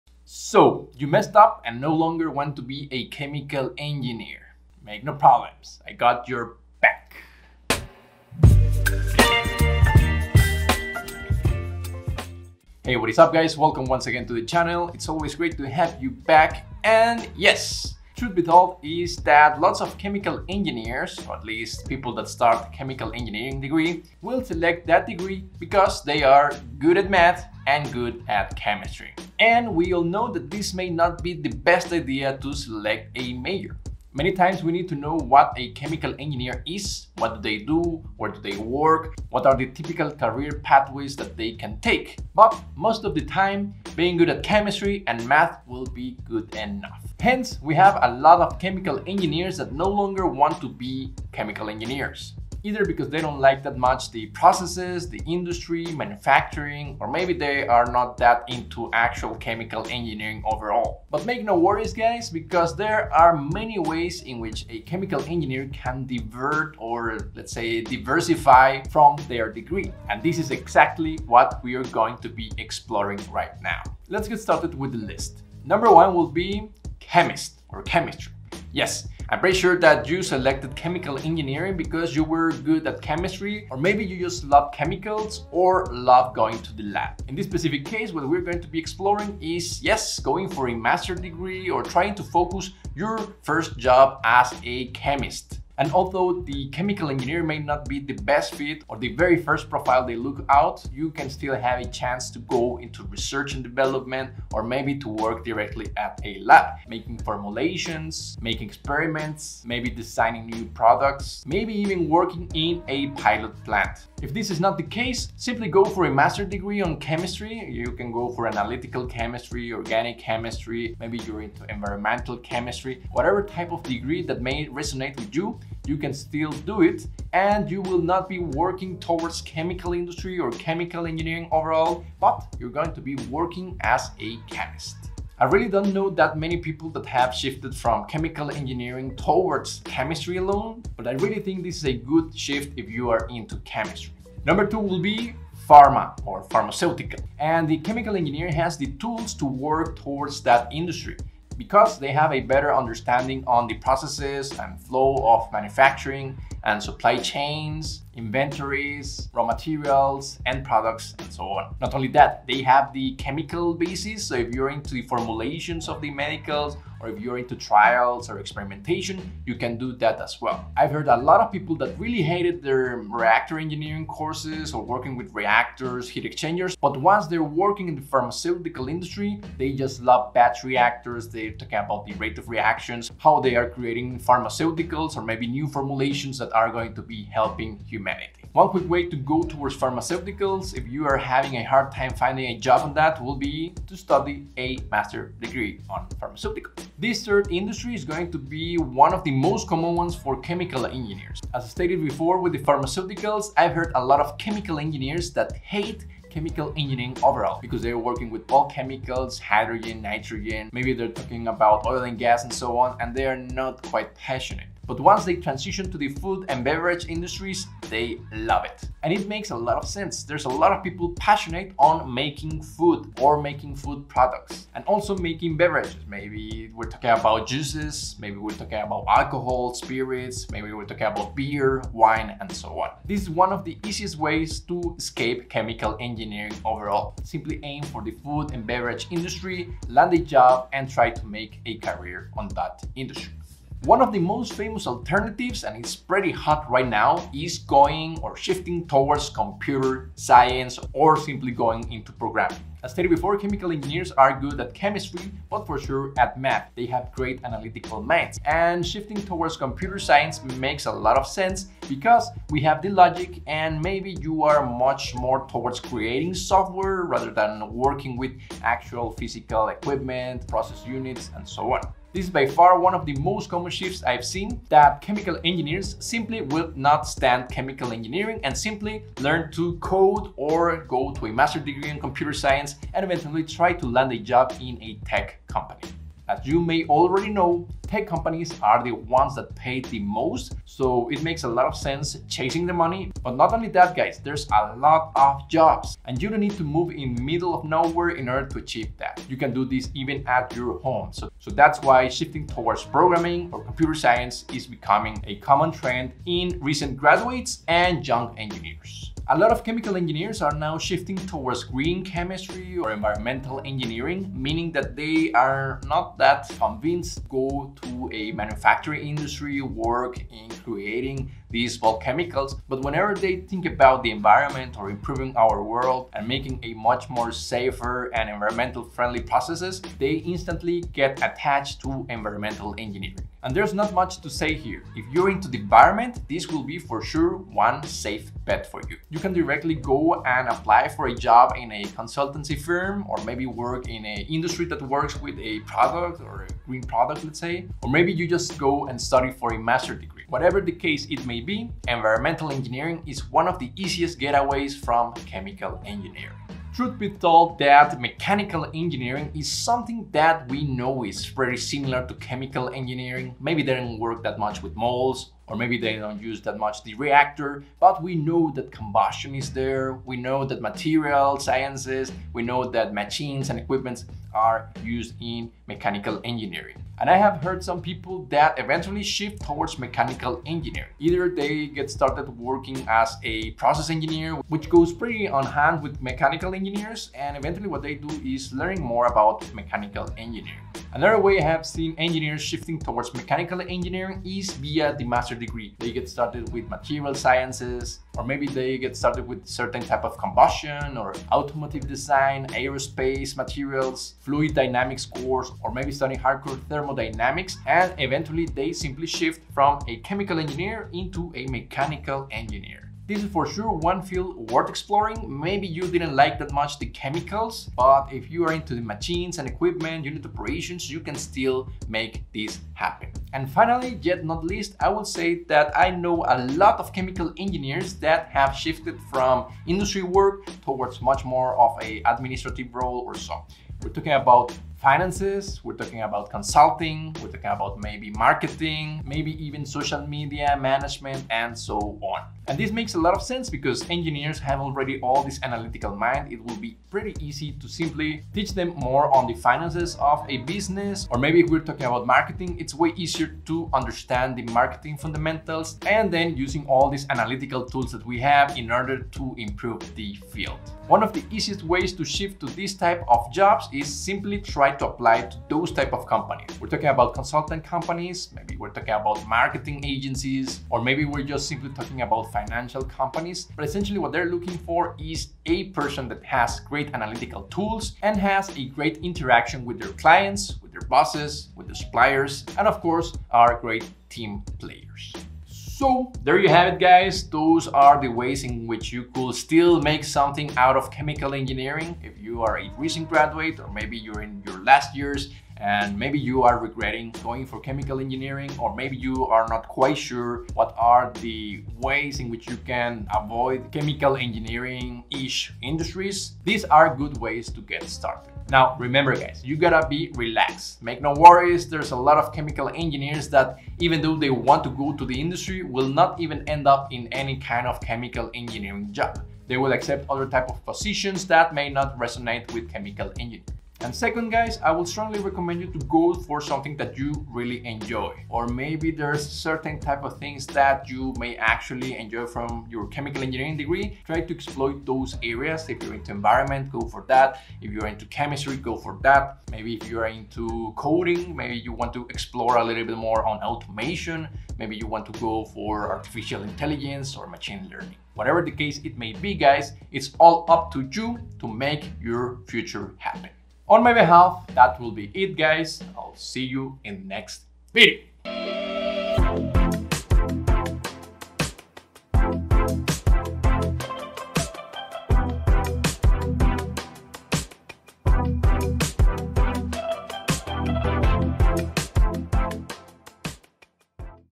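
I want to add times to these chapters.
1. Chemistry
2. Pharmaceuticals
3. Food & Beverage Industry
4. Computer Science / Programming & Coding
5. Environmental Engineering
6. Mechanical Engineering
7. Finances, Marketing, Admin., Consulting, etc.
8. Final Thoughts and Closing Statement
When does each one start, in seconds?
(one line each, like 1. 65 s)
1. 75 s
2. 144 s
3. 196 s
4. 243 s
5. 308 s
6. 356 s
7. 422 s
8. 484 s.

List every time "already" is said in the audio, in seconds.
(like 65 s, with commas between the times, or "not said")
286 s, 444 s.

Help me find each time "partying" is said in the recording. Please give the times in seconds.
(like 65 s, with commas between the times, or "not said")
not said.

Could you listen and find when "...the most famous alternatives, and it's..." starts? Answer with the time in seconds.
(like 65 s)
244 s.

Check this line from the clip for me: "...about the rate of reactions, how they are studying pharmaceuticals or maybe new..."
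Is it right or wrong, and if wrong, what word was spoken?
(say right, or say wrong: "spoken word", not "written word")
wrong: "creating", not "studying".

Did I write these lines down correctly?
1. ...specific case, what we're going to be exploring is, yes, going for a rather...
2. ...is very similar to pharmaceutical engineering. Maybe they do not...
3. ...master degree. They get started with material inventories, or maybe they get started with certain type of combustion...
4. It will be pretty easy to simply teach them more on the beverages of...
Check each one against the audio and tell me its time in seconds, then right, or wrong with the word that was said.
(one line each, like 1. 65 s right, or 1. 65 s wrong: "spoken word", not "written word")
1. 87 s wrong: "master", not "rather"
2. 361 s wrong: "chemical", not "pharmaceutical"
3. 395 s wrong: "sciences", not "inventories"
4. 446 s wrong: "finances", not "beverages".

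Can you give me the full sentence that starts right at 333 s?
And there's not much to say here.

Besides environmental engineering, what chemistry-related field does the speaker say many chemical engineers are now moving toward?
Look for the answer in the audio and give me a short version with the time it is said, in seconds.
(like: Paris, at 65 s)
Green chemistry, at 311 s.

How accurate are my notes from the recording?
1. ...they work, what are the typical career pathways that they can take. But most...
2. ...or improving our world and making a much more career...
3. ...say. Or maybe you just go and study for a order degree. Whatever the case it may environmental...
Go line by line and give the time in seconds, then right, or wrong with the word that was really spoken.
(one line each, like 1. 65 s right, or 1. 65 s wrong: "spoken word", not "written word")
1. 38 s right
2. 324 s wrong: "safer", not "career"
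3. 347 s wrong: "master", not "order".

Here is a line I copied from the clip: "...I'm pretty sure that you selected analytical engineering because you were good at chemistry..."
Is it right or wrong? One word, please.
wrong.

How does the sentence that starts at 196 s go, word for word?
This third industry is going to be one of the most common ones for chemical engineers.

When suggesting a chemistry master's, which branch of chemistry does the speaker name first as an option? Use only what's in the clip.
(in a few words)
Analytical chemistry.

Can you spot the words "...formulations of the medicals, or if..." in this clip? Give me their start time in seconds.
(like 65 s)
165 s.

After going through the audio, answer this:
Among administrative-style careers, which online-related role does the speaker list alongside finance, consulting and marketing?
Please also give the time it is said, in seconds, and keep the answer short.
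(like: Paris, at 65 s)
Social media management, at 439 s.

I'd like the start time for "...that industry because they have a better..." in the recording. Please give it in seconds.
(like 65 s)
150 s.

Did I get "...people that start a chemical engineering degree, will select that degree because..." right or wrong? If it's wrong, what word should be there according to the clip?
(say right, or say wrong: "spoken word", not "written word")
right.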